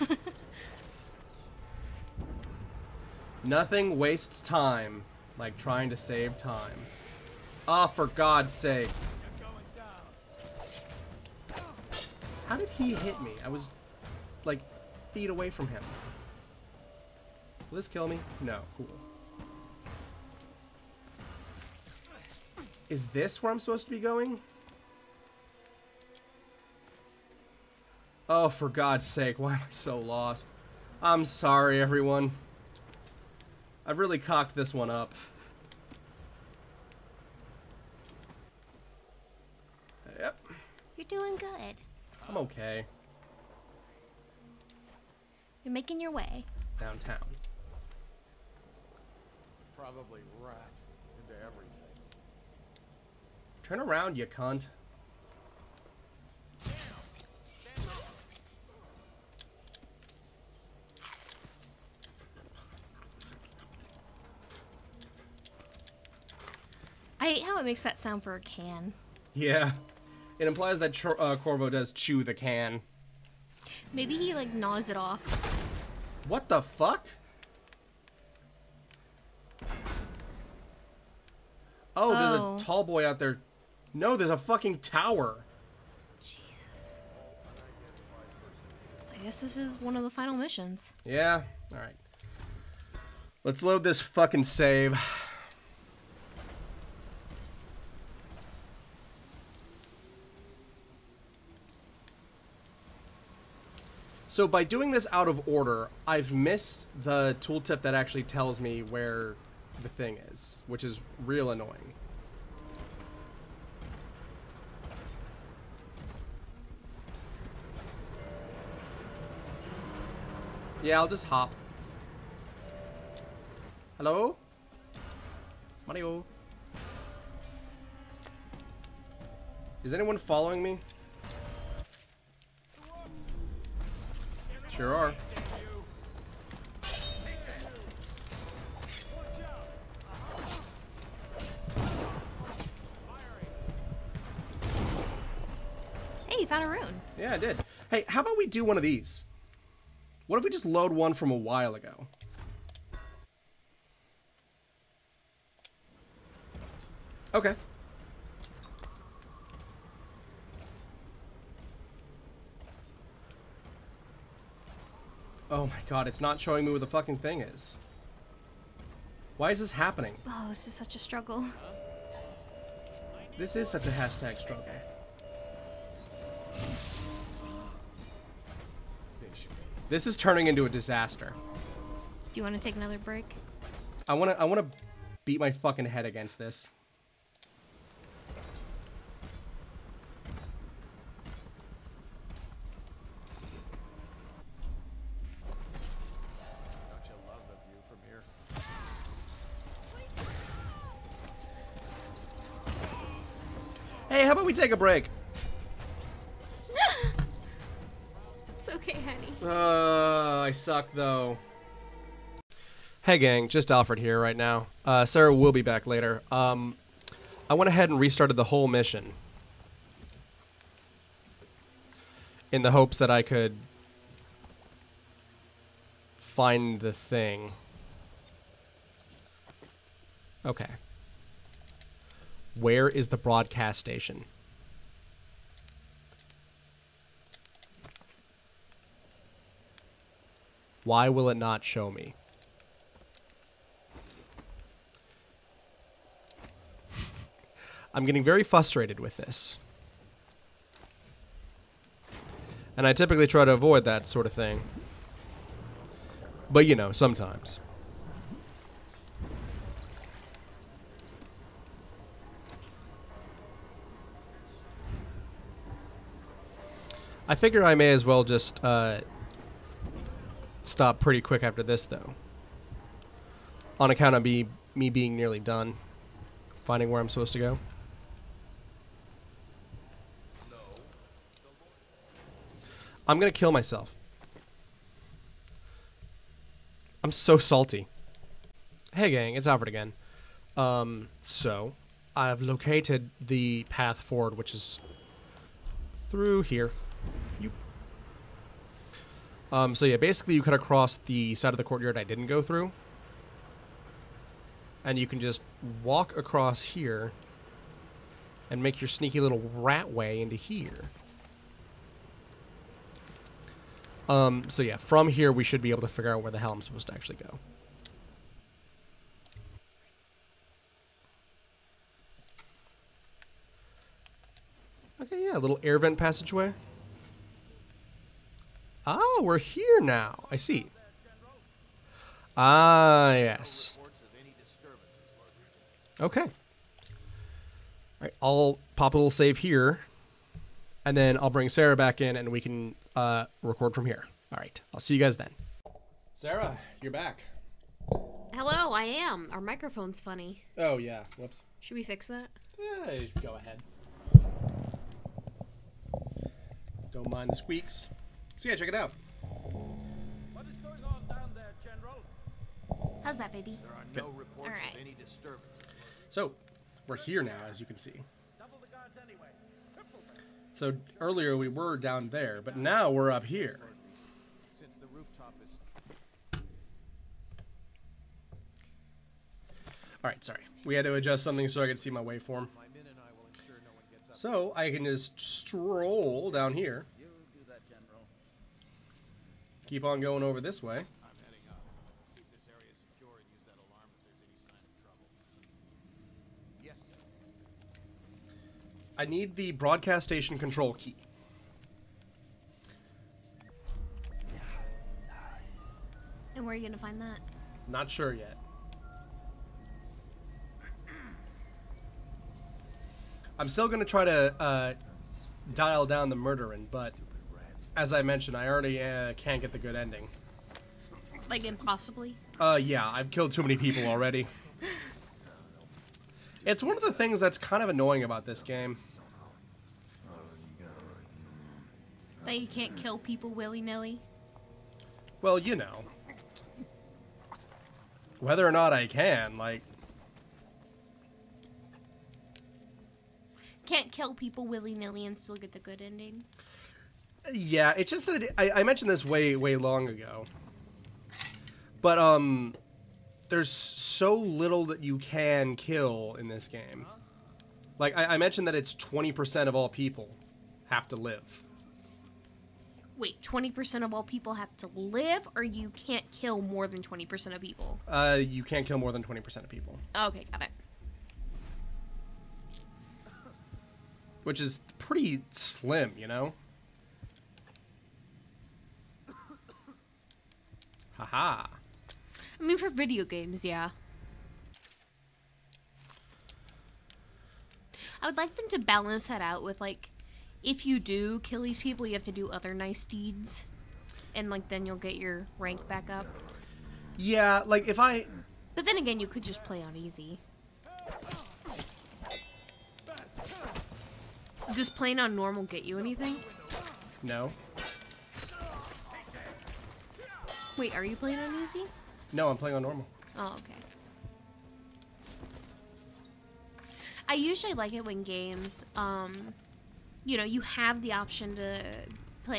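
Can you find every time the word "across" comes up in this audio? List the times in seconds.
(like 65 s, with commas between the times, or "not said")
300 s, 306 s.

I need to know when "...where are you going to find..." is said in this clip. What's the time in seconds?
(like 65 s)
406 s.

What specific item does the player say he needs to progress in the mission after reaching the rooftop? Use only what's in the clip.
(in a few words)
broadcast station control key.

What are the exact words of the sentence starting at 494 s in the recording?
And, like, then you'll get your rank back up.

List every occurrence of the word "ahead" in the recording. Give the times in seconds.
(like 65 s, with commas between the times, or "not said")
217 s, 353 s.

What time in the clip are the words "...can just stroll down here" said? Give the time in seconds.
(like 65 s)
384 s.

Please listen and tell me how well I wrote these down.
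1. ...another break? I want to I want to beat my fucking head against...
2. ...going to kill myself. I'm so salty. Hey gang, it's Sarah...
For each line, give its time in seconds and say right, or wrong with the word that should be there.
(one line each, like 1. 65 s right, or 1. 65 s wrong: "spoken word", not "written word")
1. 182 s right
2. 283 s wrong: "Alfred", not "Sarah".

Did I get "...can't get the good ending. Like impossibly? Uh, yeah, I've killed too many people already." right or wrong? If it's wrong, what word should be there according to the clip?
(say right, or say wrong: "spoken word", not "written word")
right.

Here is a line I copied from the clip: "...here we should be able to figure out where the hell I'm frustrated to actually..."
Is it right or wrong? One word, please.
wrong.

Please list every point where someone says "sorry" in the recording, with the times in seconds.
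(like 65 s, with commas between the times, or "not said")
31 s, 380 s.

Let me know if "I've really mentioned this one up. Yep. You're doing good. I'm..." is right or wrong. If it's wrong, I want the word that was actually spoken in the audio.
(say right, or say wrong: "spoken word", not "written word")
wrong: "cocked", not "mentioned".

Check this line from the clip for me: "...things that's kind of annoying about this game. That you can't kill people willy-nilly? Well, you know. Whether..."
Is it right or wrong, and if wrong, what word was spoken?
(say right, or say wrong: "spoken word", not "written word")
right.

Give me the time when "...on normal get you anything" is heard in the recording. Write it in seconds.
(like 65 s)
504 s.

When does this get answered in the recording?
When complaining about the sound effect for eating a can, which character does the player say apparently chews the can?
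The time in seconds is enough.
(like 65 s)
71 s.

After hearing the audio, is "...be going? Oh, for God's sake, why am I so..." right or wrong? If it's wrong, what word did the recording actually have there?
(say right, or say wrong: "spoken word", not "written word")
right.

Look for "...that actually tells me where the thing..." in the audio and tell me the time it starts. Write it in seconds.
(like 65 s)
107 s.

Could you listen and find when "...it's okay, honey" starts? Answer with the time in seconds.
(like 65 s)
208 s.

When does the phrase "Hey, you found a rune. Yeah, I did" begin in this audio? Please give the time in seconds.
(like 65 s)
146 s.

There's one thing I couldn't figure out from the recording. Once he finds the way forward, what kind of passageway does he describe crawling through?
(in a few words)
air vent passageway.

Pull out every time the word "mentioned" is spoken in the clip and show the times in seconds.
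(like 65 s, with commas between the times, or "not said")
418 s, 448 s, 458 s.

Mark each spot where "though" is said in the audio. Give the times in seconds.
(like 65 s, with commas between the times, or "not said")
210 s, 271 s.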